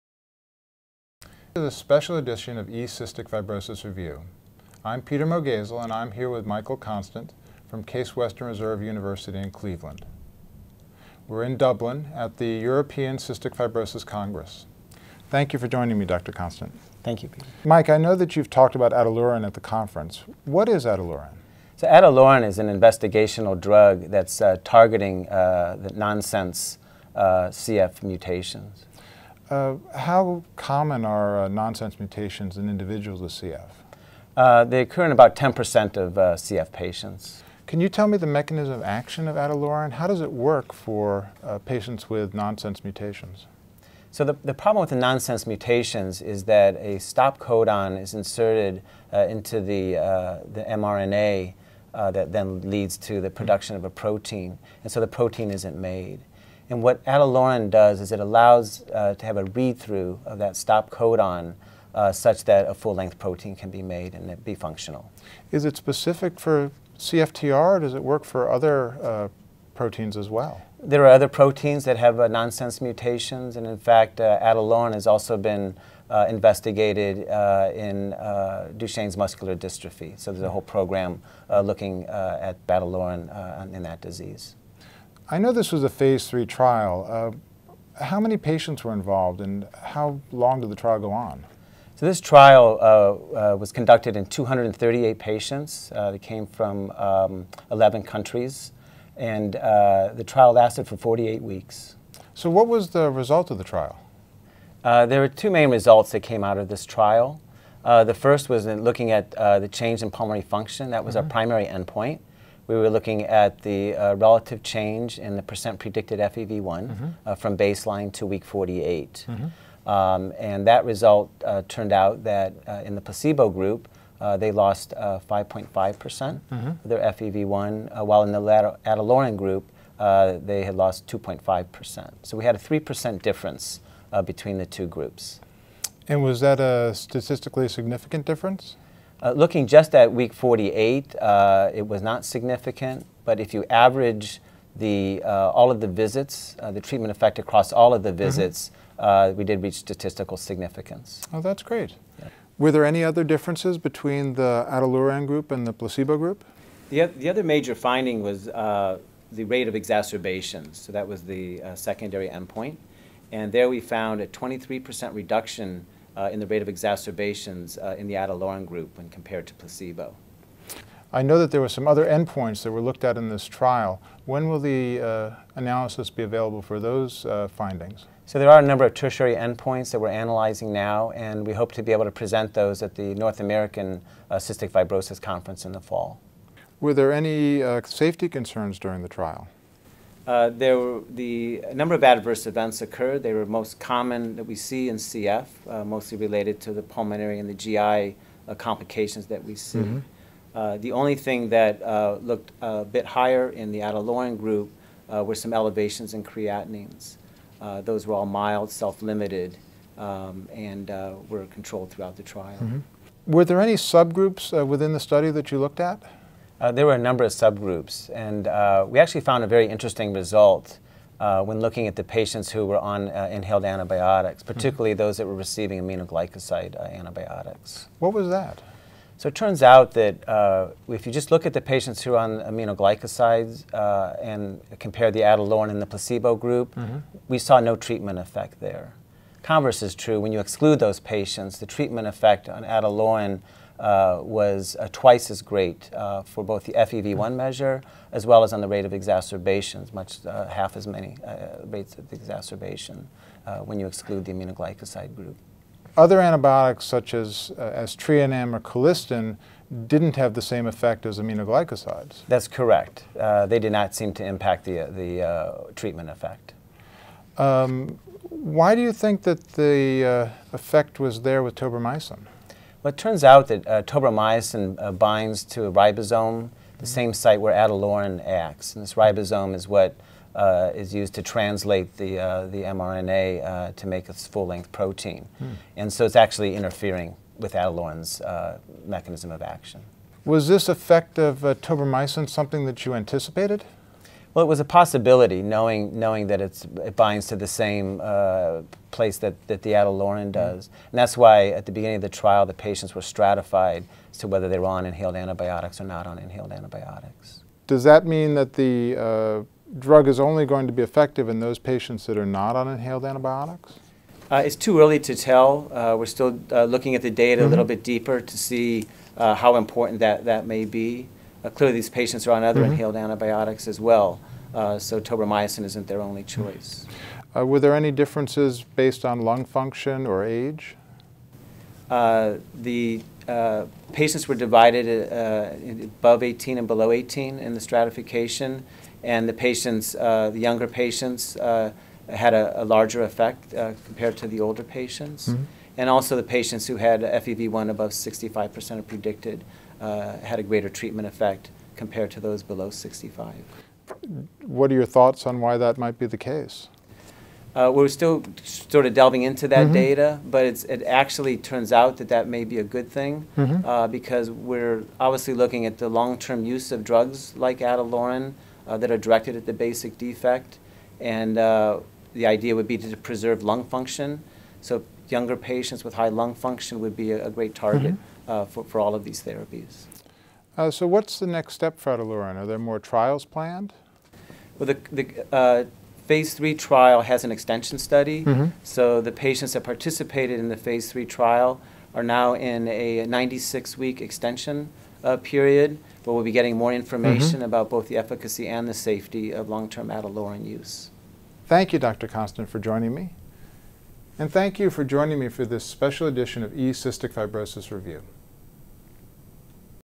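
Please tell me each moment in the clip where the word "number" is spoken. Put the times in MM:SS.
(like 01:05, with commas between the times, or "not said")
02:58, 03:11, 03:36.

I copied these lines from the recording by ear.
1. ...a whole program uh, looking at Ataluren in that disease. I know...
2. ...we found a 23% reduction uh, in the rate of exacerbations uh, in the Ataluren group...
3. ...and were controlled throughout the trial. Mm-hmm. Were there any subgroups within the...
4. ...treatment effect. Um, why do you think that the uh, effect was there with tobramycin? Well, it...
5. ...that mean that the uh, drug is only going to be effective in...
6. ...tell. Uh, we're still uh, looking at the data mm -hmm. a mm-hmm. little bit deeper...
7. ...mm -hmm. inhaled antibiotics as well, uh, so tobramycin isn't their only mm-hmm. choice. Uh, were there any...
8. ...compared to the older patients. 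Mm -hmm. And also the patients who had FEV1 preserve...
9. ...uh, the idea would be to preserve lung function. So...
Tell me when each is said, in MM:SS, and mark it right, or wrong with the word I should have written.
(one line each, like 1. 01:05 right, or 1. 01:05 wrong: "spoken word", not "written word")
1. 01:20 right
2. 02:43 right
3. 03:30 right
4. 04:25 right
5. 05:07 right
6. 05:15 right
7. 05:22 right
8. 05:43 wrong: "above", not "preserve"
9. 06:11 right.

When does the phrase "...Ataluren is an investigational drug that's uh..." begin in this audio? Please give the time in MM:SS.
00:21.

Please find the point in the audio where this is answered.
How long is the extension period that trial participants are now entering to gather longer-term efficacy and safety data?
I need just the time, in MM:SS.
06:33.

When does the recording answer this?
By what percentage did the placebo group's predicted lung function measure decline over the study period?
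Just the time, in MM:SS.
02:05.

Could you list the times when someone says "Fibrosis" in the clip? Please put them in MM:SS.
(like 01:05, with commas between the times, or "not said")
00:03, 00:13, 03:04, 06:47.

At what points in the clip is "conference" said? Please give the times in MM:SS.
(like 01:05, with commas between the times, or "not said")
00:19, 03:05.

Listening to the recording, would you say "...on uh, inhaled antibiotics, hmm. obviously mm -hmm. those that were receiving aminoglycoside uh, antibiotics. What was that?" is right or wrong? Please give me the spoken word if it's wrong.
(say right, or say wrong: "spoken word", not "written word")
wrong: "particularly", not "obviously".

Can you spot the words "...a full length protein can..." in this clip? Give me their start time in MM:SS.
01:02.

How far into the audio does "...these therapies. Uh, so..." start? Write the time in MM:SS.
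06:19.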